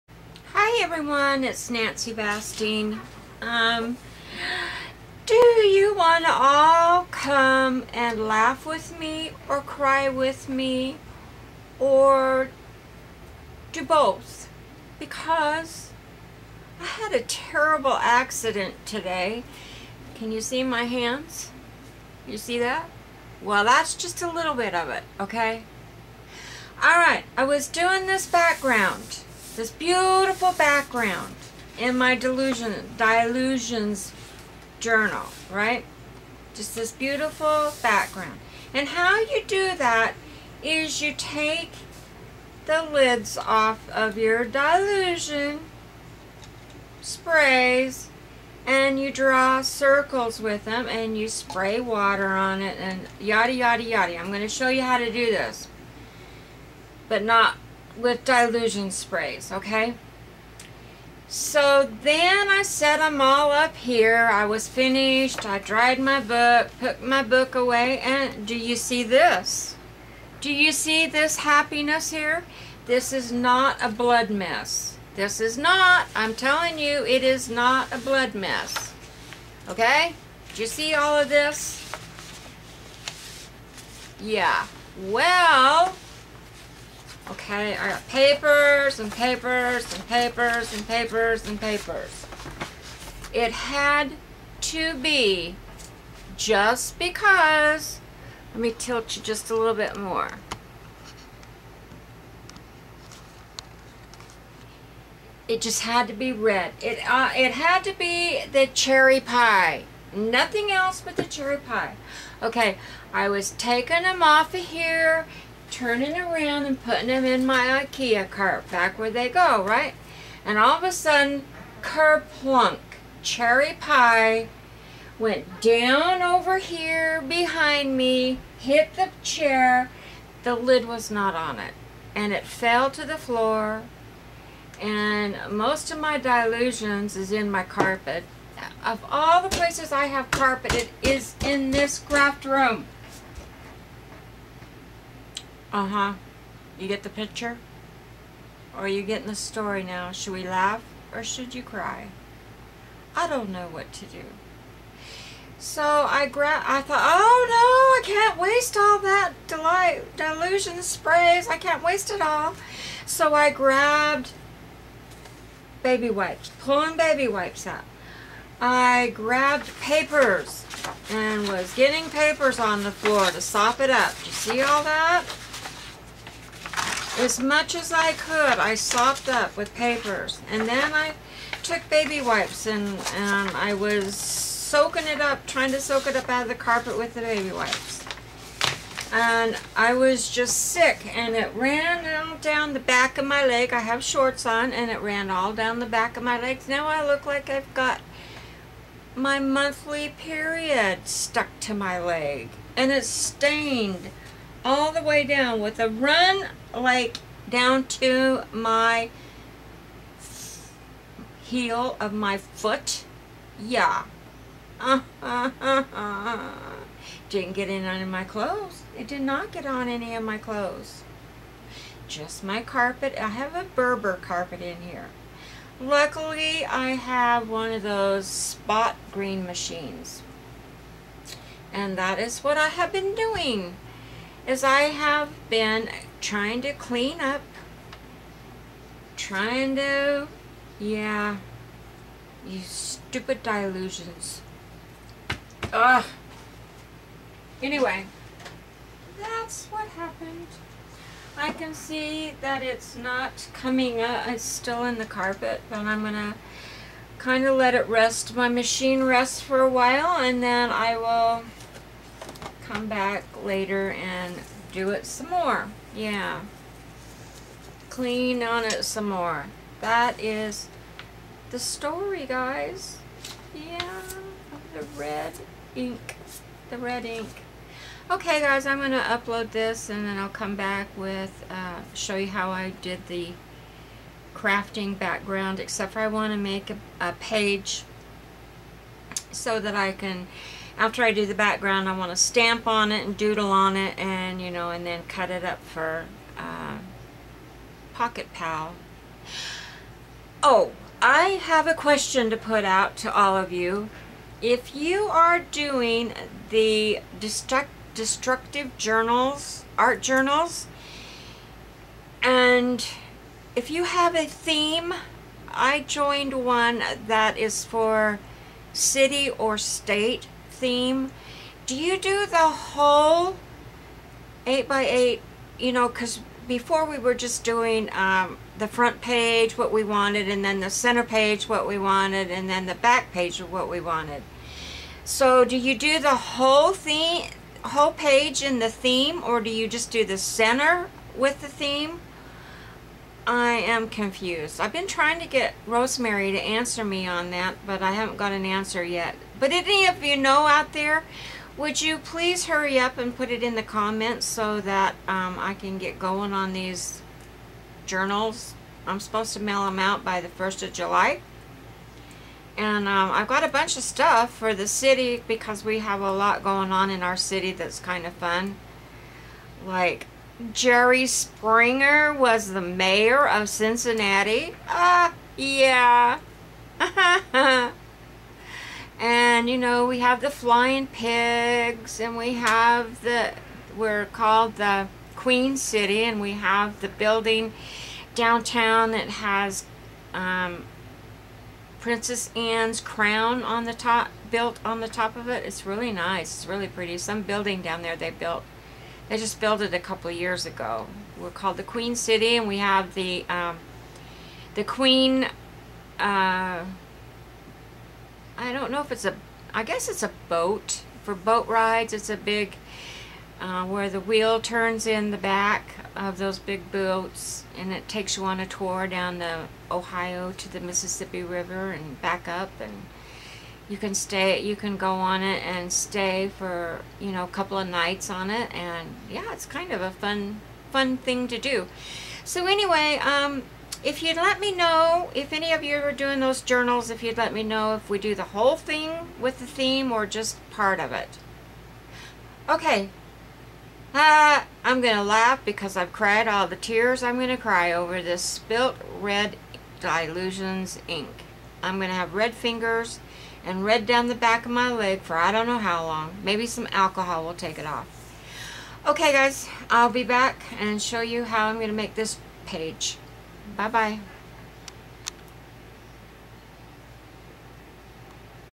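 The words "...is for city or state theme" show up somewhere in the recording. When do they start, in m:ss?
5:17.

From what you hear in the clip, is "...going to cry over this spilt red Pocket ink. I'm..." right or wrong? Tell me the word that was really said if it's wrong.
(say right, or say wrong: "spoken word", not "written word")
wrong: "Dylusions", not "Pocket".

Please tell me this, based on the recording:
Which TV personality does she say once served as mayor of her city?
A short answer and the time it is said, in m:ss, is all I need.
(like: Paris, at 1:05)
Jerry Springer, at 6:10.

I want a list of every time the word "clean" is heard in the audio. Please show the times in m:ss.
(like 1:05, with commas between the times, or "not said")
3:56, 4:27.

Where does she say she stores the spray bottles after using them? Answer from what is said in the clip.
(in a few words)
IKEA cart.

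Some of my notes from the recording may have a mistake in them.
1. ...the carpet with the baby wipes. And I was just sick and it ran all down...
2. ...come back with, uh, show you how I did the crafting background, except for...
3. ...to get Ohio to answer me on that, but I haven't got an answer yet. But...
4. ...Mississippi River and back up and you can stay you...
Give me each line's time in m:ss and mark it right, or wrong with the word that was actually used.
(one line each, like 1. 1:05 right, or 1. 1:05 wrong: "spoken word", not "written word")
1. 3:06 right
2. 4:40 right
3. 5:45 wrong: "Rosemary", not "Ohio"
4. 7:00 right.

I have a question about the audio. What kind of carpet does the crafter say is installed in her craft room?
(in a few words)
Berber.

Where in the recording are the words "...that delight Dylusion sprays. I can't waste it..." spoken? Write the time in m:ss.
2:38.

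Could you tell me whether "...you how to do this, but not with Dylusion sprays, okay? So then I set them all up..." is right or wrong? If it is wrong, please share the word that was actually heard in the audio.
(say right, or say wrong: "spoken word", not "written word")
right.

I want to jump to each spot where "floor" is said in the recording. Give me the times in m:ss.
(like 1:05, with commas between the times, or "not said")
2:13, 2:52.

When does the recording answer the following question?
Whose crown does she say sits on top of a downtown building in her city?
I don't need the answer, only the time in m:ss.
6:31.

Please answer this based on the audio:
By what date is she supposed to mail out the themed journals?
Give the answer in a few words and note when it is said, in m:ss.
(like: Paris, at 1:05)
1st of July, at 6:00.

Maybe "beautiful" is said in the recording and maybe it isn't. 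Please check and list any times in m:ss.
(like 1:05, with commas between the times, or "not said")
0:29, 0:36.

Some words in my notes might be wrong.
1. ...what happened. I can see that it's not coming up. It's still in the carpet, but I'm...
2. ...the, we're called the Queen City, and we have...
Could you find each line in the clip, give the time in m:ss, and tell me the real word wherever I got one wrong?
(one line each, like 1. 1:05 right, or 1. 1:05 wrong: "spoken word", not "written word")
1. 4:09 right
2. 6:23 right.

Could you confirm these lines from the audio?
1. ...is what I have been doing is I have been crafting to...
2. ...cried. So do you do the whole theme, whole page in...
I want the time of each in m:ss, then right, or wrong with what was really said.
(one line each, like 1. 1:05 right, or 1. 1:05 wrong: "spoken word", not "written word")
1. 3:52 wrong: "trying", not "crafting"
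2. 5:33 wrong: "wanted", not "cried".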